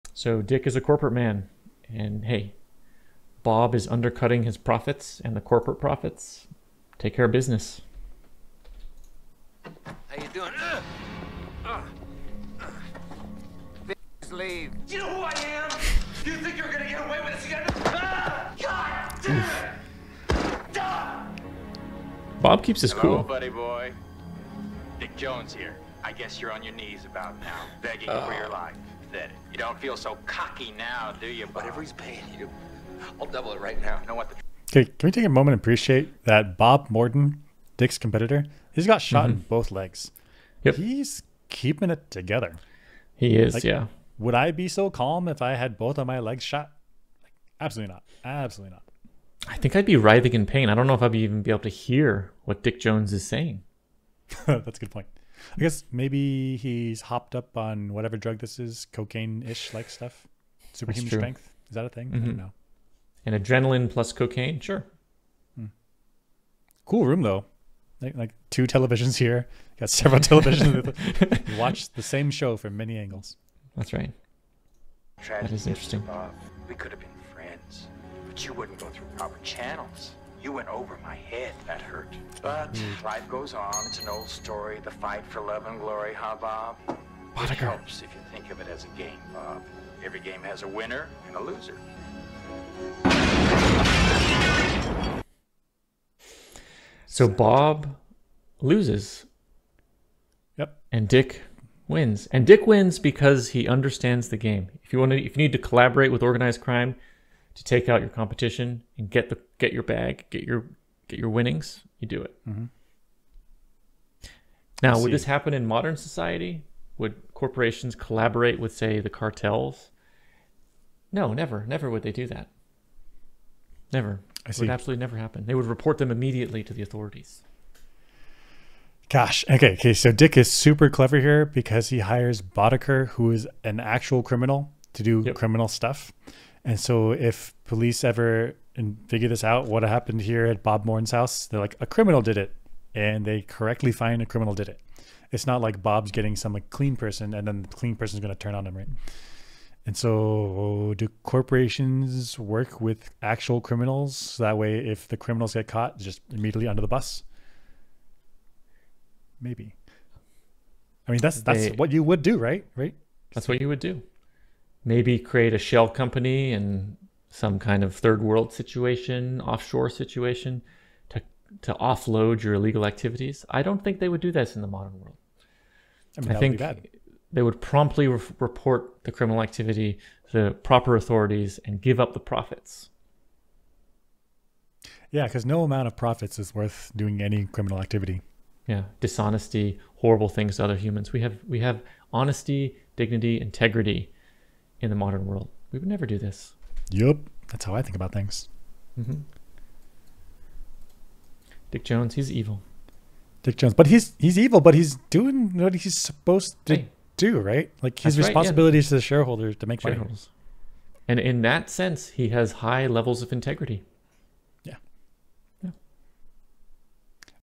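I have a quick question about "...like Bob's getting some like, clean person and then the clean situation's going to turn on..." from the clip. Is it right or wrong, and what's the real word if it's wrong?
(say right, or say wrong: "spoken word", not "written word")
wrong: "person", not "situation".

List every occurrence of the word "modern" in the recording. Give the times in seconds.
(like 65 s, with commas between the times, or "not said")
115 s, 174 s, 194 s.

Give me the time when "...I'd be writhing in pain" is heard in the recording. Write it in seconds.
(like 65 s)
49 s.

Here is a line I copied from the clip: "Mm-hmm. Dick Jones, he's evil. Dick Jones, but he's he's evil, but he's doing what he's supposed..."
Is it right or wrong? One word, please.
right.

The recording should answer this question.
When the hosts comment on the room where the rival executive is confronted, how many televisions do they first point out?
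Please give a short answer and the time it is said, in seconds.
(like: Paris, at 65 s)
2, at 68 s.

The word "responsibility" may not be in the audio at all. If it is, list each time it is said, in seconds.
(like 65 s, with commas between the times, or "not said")
208 s.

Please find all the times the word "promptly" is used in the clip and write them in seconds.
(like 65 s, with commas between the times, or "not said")
177 s.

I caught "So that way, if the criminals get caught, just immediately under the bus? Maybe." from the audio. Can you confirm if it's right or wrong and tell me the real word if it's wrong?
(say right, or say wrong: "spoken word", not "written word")
right.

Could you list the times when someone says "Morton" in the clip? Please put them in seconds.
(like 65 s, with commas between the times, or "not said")
36 s, 140 s.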